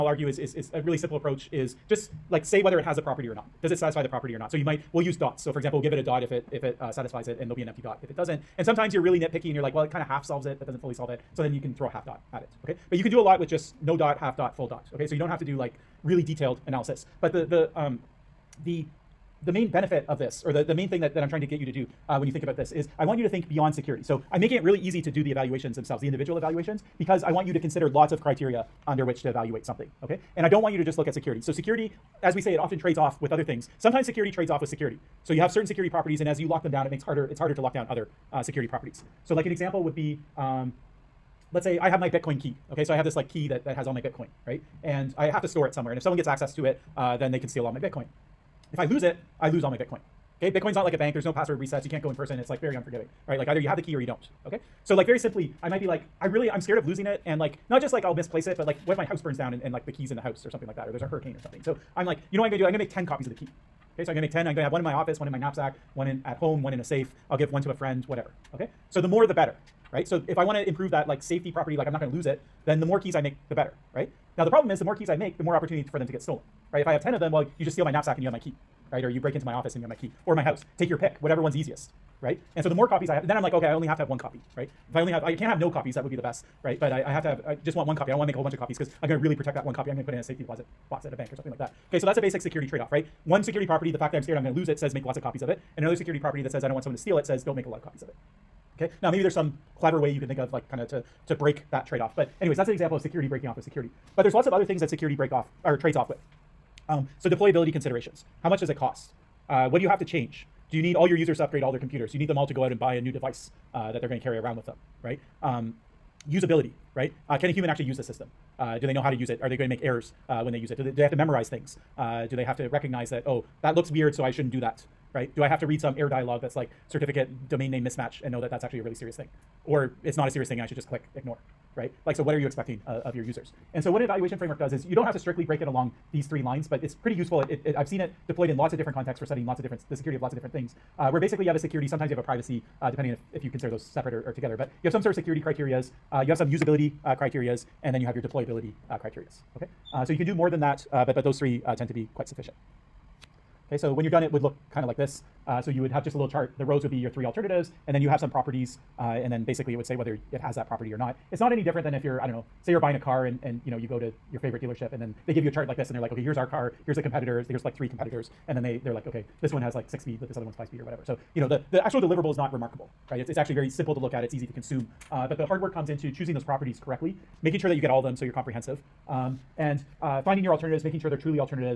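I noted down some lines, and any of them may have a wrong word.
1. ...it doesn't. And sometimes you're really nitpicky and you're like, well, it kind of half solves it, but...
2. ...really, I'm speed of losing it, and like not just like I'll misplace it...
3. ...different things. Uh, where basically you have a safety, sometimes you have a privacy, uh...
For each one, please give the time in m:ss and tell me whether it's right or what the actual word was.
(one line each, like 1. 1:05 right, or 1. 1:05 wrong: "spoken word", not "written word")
1. 0:08 right
2. 0:56 wrong: "scared", not "speed"
3. 2:20 wrong: "security", not "safety".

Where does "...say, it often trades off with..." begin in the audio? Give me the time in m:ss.
0:32.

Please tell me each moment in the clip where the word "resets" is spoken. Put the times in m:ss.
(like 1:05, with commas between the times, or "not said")
0:51.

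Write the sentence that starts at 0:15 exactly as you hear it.
So you don't have to do like, really detailed analysis.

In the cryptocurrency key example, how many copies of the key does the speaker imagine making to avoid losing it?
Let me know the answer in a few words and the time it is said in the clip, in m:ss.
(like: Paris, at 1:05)
10, at 1:02.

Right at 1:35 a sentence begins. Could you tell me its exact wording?
And another security property that says I don't want someone to steal it says don't make a lot of copies of it.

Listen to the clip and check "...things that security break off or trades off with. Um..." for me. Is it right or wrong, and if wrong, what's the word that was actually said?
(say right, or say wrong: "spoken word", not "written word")
right.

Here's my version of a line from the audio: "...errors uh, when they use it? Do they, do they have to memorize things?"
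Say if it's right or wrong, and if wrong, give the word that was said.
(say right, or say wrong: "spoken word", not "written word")
right.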